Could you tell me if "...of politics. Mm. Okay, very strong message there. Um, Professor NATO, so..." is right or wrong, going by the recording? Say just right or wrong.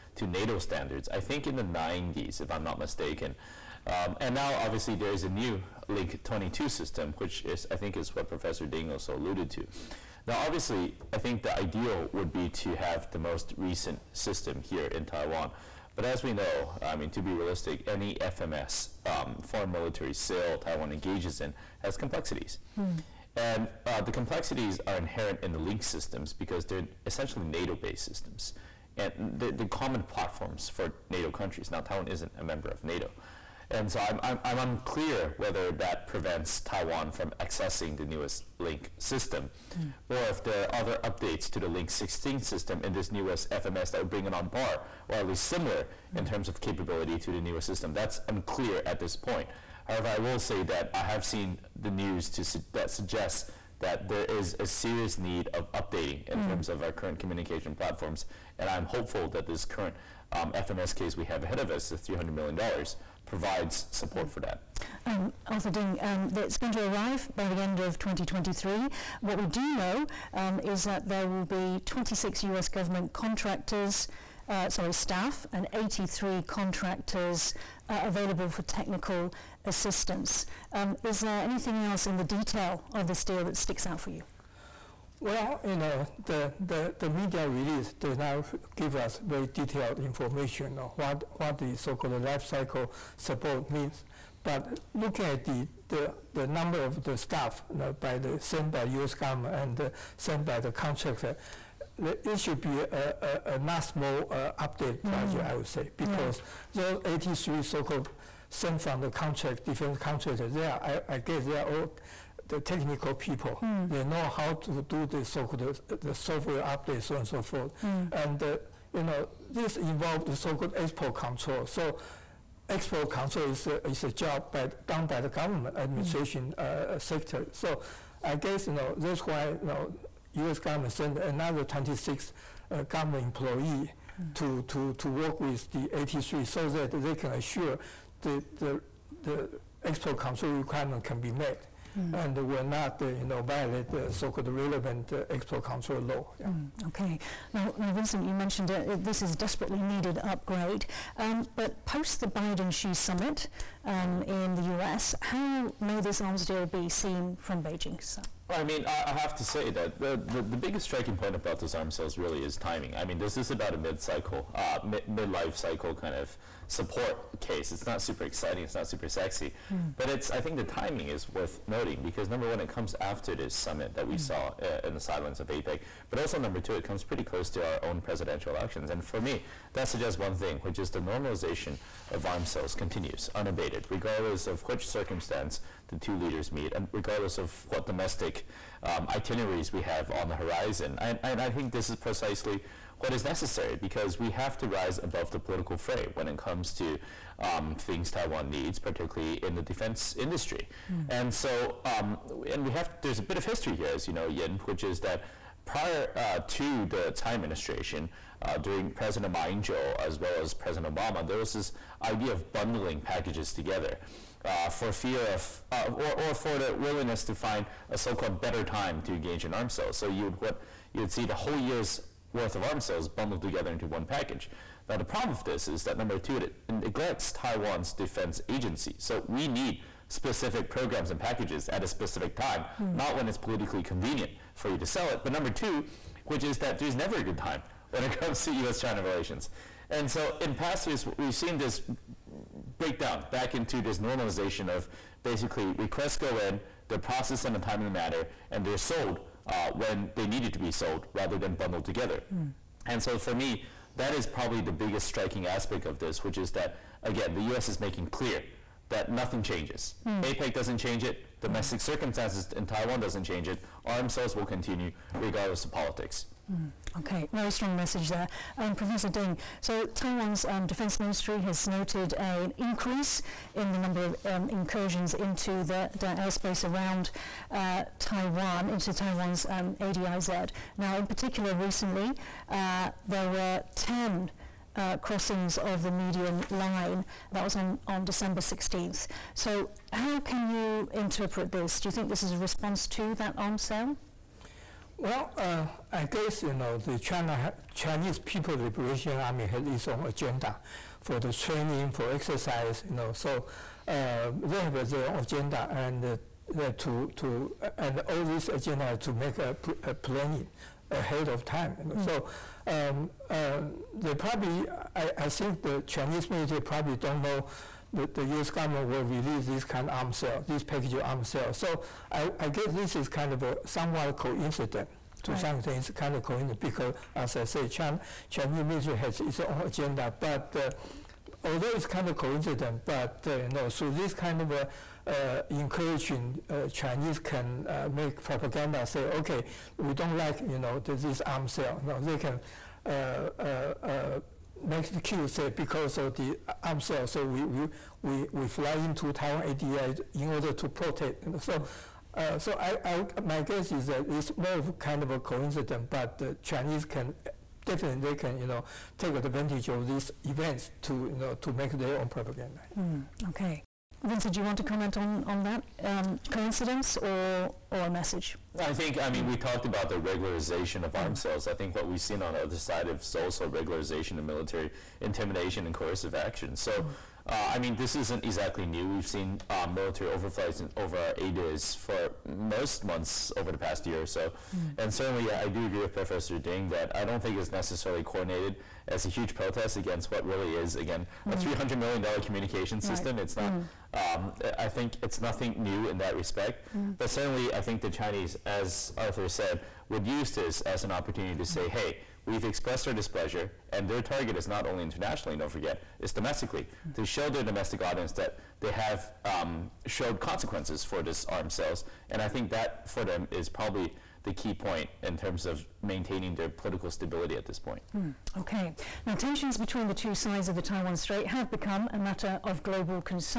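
wrong.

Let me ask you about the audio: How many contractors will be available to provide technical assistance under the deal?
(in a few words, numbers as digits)
83.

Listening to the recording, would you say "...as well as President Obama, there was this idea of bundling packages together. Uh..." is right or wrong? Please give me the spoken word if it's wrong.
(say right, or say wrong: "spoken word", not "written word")
right.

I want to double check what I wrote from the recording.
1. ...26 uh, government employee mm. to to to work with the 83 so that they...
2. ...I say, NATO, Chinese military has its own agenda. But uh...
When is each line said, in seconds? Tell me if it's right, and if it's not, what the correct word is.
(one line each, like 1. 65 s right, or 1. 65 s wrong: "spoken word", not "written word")
1. 131 s right
2. 327 s wrong: "China", not "NATO".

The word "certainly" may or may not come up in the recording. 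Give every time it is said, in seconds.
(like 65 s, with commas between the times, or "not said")
384 s, 397 s.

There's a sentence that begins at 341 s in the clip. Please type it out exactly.
No, they can uh, uh, uh, makes the queue say because of the arm sale.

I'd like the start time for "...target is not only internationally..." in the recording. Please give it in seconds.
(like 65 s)
403 s.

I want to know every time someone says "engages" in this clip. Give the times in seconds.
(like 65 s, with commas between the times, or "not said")
20 s, 219 s.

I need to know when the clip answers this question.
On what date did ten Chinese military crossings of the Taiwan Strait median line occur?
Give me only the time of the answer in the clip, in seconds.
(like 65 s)
288 s.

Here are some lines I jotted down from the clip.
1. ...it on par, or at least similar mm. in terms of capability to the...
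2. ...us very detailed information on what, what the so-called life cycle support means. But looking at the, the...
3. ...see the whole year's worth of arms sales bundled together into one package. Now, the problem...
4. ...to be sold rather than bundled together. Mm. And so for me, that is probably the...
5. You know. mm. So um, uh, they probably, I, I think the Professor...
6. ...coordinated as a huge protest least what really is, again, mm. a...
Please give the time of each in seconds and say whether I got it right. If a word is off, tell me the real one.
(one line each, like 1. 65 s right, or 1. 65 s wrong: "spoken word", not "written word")
1. 44 s right
2. 88 s right
3. 221 s right
4. 250 s right
5. 311 s wrong: "Chinese", not "Professor"
6. 388 s wrong: "against", not "least".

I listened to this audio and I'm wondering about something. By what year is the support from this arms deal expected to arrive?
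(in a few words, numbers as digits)
2023.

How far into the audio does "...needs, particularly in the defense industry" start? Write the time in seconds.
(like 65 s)
198 s.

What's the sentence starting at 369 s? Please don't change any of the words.
talked about the regularization of arms sales.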